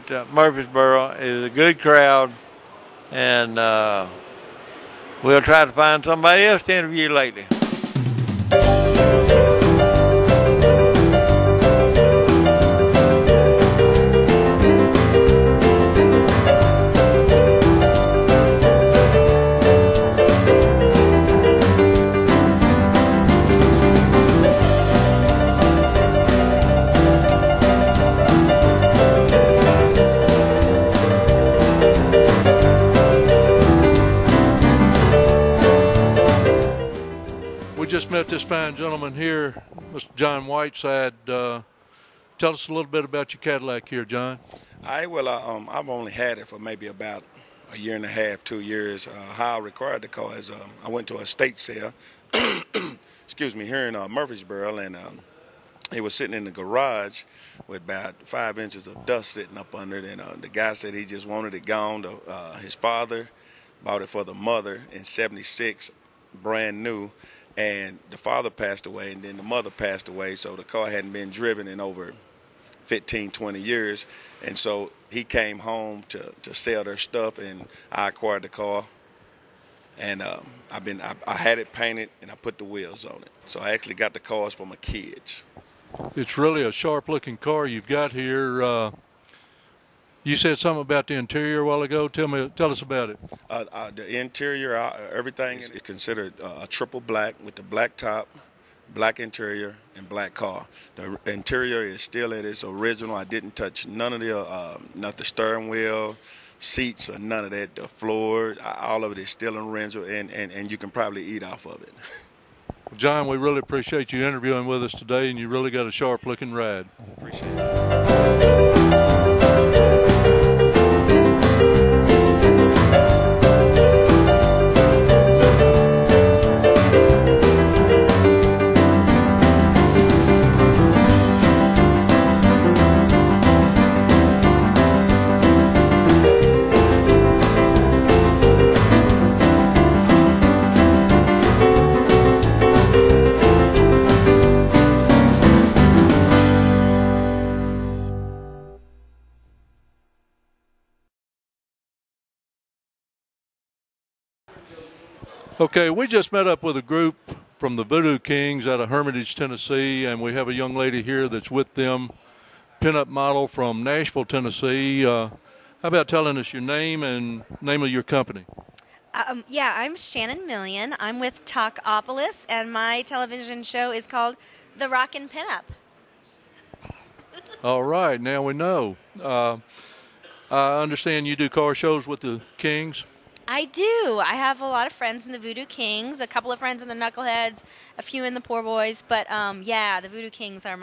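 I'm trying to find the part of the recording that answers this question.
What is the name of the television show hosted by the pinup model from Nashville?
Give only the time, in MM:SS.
02:54.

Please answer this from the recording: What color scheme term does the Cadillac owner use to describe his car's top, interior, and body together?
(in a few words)
triple black.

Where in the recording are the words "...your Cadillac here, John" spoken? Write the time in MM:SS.
00:43.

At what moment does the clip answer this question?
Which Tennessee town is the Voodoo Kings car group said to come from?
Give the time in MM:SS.
02:38.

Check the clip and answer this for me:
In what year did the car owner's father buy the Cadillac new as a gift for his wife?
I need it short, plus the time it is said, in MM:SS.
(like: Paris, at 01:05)
1976, at 01:05.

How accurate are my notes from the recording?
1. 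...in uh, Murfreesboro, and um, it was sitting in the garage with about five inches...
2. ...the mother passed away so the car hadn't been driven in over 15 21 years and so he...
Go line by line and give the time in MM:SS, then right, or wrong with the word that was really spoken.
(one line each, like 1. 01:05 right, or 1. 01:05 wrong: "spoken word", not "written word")
1. 00:53 right
2. 01:09 wrong: "20", not "21".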